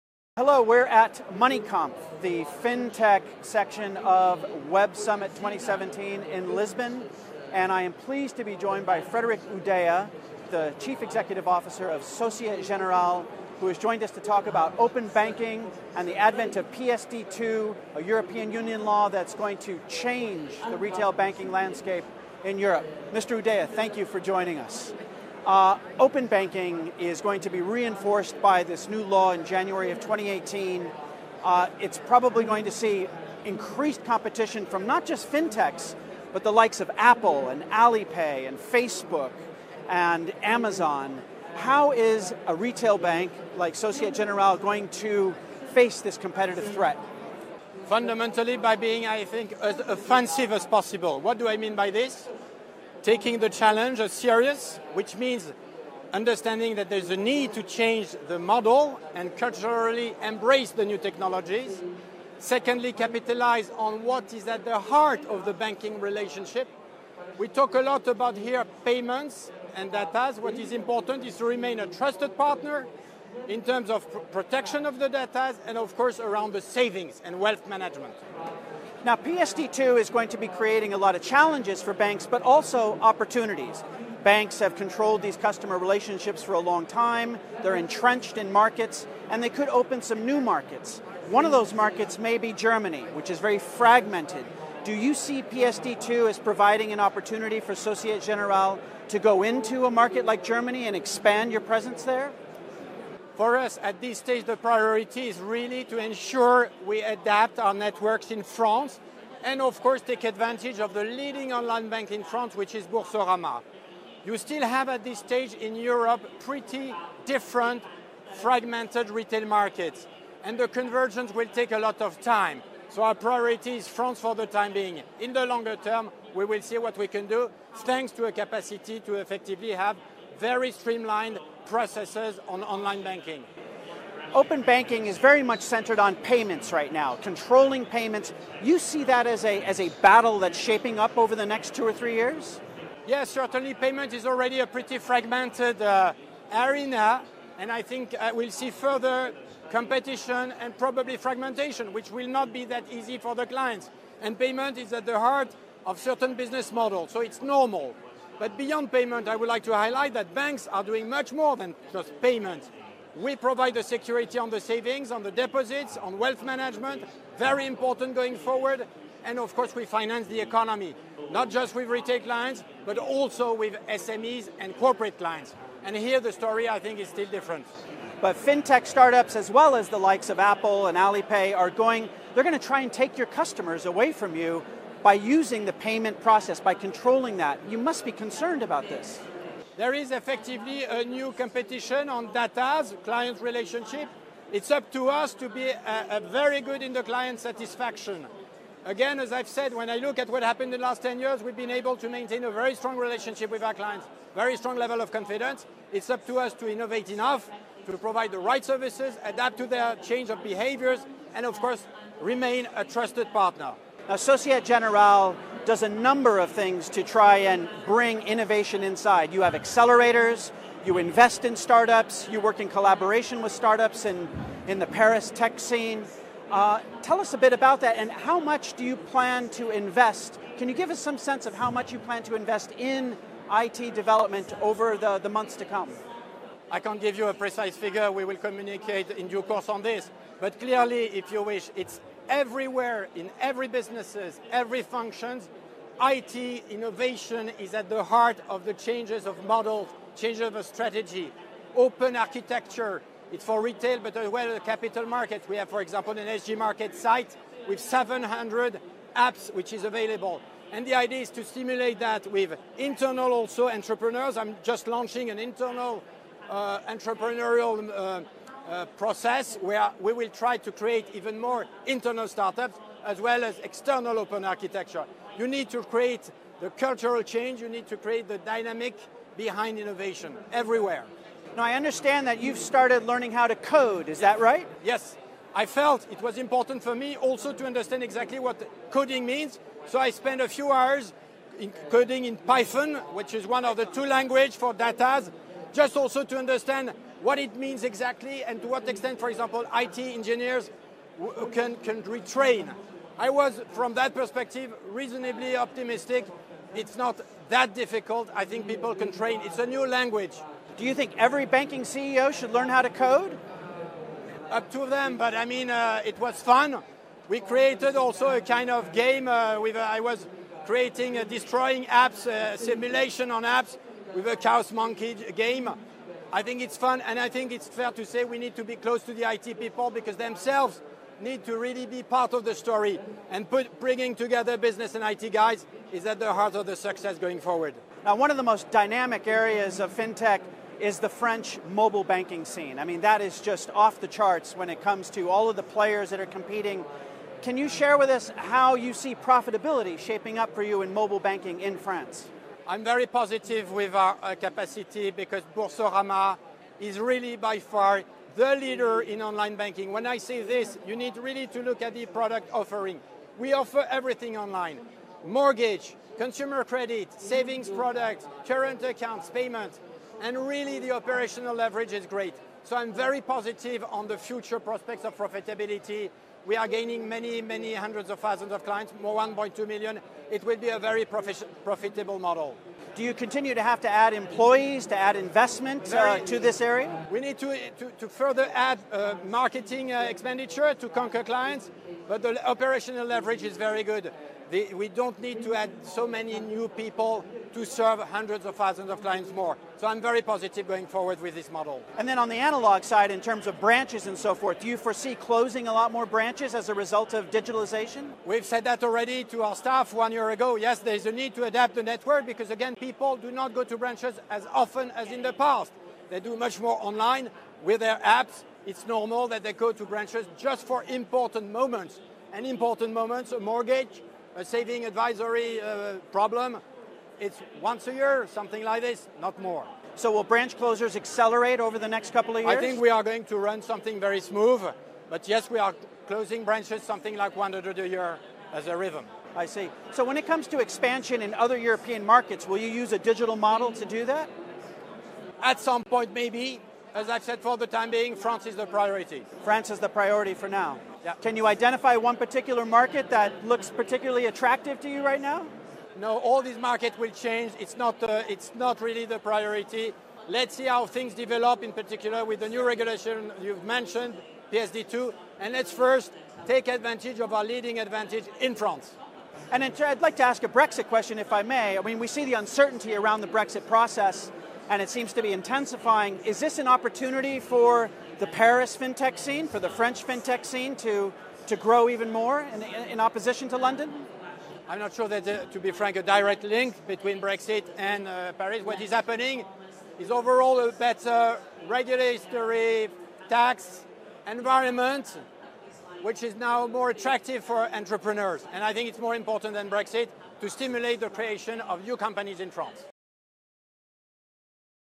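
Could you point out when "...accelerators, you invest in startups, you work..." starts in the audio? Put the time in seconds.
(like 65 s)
219 s.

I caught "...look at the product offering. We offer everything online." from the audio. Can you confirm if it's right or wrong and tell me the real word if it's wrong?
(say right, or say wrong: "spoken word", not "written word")
right.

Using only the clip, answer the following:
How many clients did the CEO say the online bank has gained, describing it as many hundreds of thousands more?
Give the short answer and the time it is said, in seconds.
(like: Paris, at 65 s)
1.2 million, at 379 s.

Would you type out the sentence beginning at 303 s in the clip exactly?
I was, from that perspective, reasonably optimistic.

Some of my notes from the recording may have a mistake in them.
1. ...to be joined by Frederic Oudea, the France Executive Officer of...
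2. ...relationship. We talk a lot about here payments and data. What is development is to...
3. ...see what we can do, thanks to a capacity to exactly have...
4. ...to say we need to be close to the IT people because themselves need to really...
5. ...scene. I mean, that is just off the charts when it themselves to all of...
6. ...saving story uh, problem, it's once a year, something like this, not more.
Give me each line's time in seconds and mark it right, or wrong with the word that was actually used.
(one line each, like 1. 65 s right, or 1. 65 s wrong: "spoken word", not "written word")
1. 8 s wrong: "Chief", not "France"
2. 65 s wrong: "important", not "development"
3. 126 s wrong: "effectively", not "exactly"
4. 327 s right
5. 342 s wrong: "comes", not "themselves"
6. 424 s wrong: "advisory", not "story".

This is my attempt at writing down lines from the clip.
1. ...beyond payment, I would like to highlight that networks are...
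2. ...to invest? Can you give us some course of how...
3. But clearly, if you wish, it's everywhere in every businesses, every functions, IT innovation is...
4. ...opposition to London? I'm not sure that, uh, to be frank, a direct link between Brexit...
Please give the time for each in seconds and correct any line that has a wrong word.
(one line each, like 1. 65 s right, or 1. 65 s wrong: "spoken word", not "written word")
1. 158 s wrong: "banks", not "networks"
2. 229 s wrong: "sense", not "course"
3. 240 s right
4. 483 s right.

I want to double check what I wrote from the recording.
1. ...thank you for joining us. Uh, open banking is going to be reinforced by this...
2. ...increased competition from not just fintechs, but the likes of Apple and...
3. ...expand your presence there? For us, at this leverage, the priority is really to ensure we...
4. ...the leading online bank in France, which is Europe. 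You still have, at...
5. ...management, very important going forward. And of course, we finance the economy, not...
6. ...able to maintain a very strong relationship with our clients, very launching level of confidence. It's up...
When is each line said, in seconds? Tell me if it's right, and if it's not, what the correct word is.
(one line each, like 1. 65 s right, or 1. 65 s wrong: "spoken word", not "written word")
1. 23 s right
2. 33 s right
3. 100 s wrong: "stage", not "leverage"
4. 110 s wrong: "Boursorama", not "Europe"
5. 166 s right
6. 201 s wrong: "strong", not "launching".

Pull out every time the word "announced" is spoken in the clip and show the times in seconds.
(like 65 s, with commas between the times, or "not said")
not said.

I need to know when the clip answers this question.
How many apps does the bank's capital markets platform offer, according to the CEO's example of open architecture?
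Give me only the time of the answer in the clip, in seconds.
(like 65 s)
257 s.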